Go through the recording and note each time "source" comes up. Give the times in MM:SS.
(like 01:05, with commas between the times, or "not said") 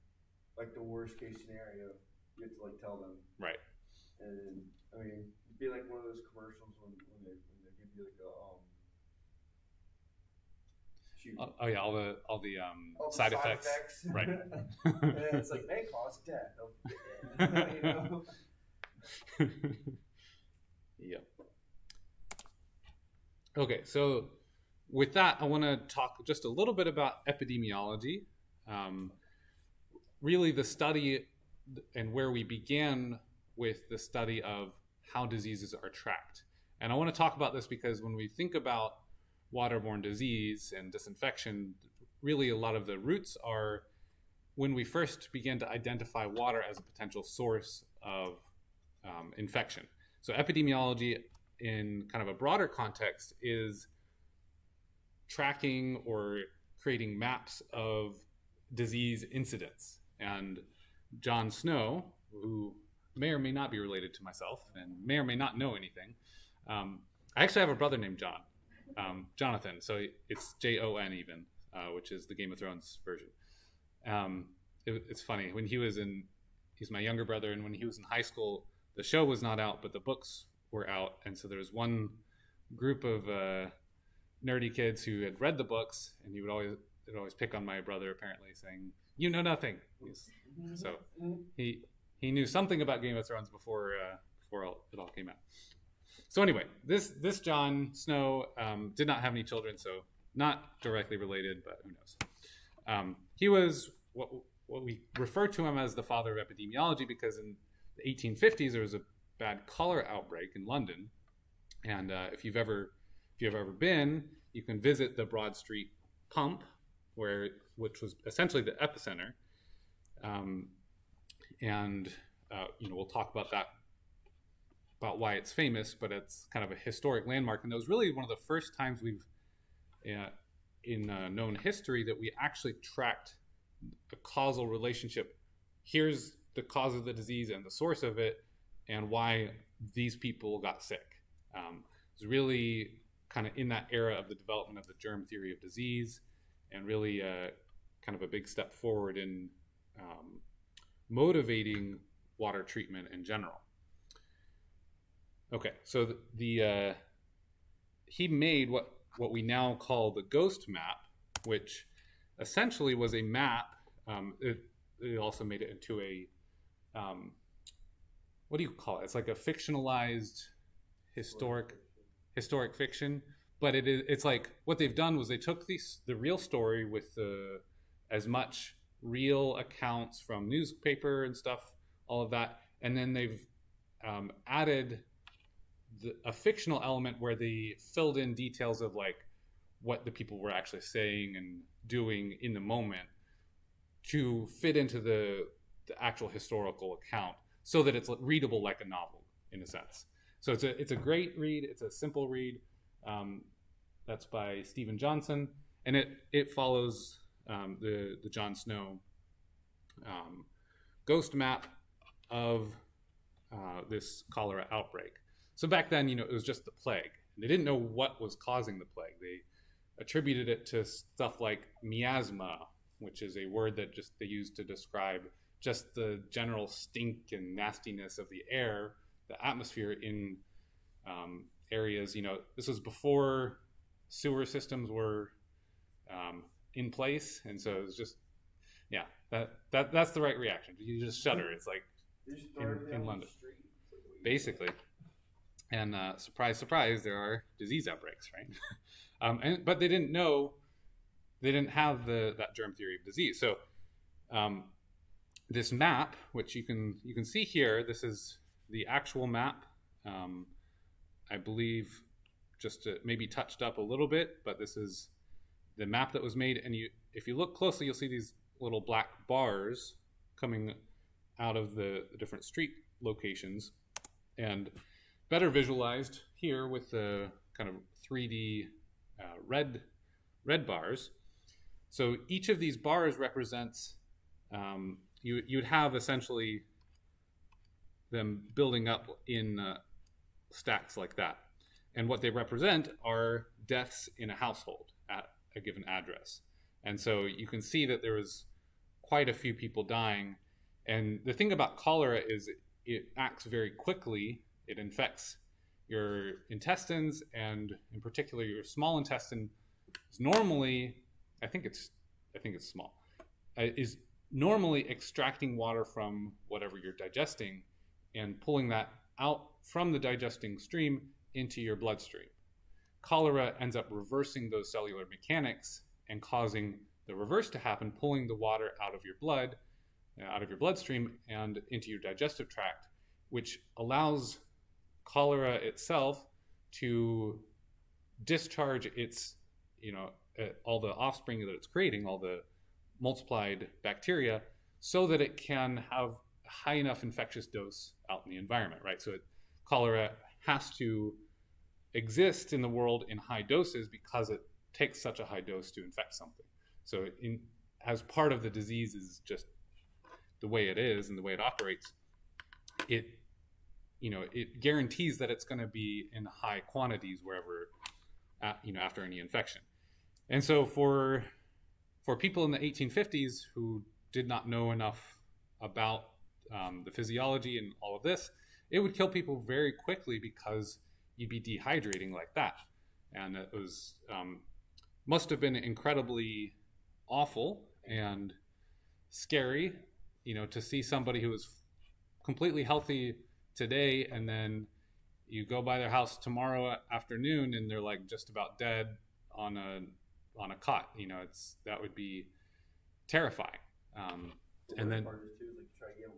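00:47, 02:17.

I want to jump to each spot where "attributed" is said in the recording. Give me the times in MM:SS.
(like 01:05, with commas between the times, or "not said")
03:39.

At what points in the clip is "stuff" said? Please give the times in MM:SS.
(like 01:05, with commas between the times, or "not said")
03:01, 03:40.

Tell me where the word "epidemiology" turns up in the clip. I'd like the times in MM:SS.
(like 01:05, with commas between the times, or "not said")
00:27, 00:50, 01:46.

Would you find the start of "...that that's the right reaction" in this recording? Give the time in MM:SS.
03:59.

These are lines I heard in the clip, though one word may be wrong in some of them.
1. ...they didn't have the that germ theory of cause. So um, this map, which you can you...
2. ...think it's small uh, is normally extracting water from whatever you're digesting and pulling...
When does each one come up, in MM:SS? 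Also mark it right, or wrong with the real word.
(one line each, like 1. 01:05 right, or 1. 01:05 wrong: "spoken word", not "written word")
1. 04:11 wrong: "disease", not "cause"
2. 05:12 right.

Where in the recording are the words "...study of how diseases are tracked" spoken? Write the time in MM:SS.
00:33.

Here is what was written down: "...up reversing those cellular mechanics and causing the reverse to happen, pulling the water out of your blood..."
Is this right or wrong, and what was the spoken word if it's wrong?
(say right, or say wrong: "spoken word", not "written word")
right.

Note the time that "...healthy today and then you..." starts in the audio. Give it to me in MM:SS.
06:32.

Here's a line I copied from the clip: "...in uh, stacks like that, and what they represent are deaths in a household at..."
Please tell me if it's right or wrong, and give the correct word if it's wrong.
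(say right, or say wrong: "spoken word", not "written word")
right.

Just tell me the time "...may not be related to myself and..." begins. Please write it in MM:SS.
01:03.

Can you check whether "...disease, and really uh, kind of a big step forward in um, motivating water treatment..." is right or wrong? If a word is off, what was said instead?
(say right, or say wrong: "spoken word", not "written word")
right.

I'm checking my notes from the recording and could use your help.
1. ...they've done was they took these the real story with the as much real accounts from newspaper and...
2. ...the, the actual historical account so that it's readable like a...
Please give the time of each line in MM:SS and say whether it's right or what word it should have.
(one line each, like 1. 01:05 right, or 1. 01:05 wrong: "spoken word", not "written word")
1. 02:54 right
2. 03:14 right.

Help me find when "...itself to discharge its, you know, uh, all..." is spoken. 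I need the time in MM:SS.
05:35.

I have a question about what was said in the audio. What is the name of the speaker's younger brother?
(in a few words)
Jonathan.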